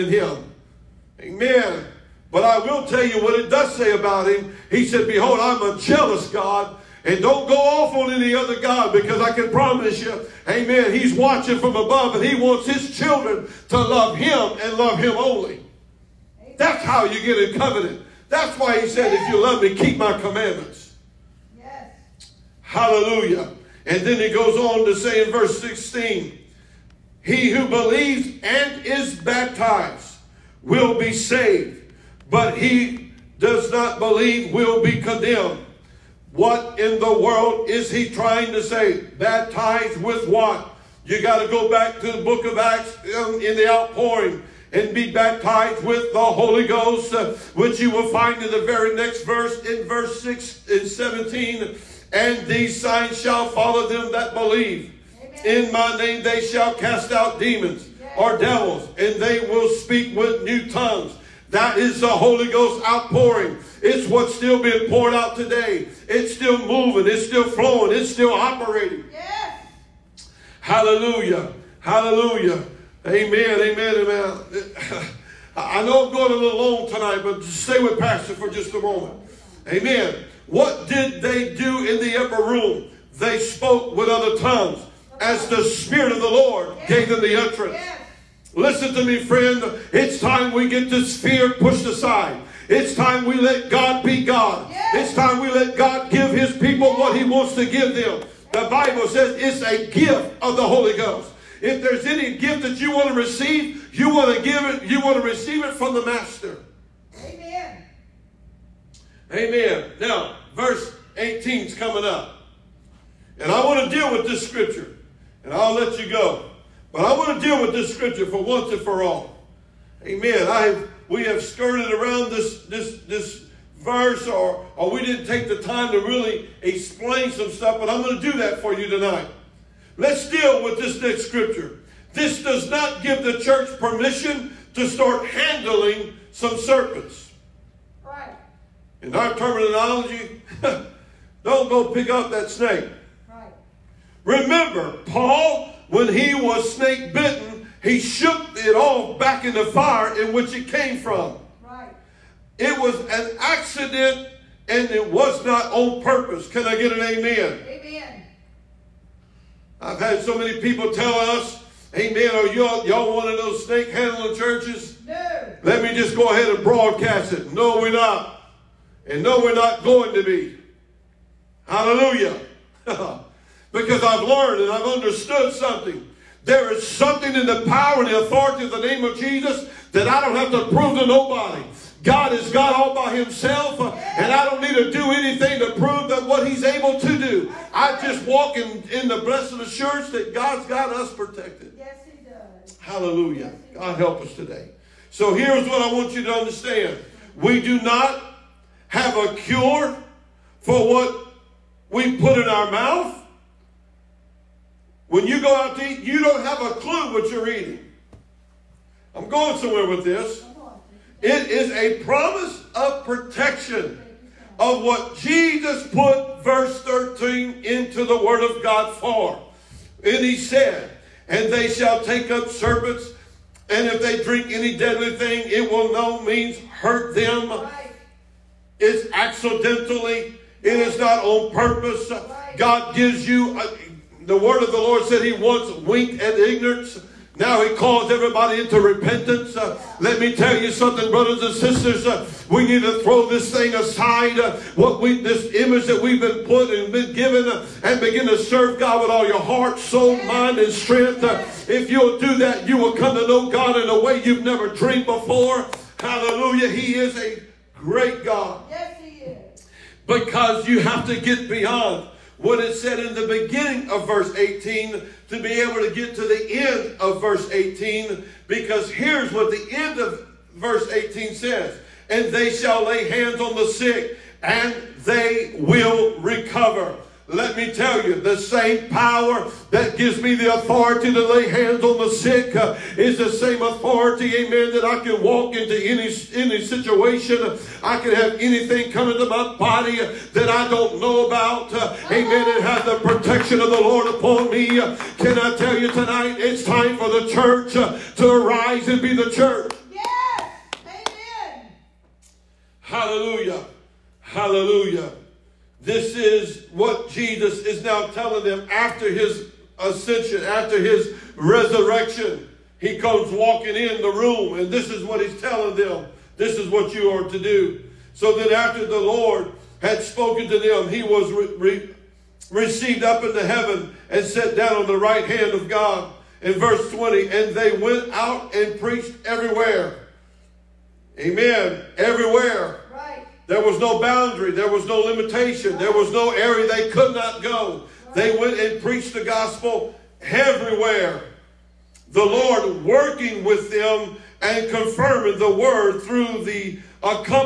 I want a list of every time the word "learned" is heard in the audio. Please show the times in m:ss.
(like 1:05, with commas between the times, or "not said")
2:54.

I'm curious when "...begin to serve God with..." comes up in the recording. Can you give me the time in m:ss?
4:07.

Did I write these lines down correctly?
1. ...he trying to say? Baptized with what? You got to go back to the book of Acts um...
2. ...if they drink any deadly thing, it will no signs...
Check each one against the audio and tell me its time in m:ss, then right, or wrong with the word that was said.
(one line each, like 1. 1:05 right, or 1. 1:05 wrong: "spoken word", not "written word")
1. 0:37 right
2. 3:43 wrong: "means", not "signs".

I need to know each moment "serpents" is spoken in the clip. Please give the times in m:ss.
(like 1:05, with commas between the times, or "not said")
2:16, 3:42.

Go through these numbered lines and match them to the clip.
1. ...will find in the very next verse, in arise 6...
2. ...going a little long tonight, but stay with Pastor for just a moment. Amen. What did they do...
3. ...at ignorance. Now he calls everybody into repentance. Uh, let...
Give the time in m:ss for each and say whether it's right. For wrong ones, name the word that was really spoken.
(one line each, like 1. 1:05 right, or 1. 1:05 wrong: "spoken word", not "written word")
1. 0:47 wrong: "verse", not "arise"
2. 1:16 right
3. 3:56 right.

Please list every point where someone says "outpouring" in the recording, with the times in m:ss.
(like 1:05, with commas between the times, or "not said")
0:43, 1:02.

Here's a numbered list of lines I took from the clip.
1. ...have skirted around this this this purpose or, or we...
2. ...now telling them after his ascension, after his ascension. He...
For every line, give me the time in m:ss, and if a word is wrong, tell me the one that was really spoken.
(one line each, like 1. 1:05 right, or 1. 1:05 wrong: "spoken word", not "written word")
1. 2:01 wrong: "verse", not "purpose"
2. 5:07 wrong: "resurrection", not "ascension".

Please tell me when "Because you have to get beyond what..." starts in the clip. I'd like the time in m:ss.
4:20.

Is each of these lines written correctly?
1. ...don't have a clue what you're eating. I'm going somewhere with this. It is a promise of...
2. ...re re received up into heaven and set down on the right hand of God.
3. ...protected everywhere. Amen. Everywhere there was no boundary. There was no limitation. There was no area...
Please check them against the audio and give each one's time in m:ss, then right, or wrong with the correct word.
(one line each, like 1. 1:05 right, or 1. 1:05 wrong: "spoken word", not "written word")
1. 3:26 right
2. 5:21 right
3. 5:28 wrong: "preached", not "protected".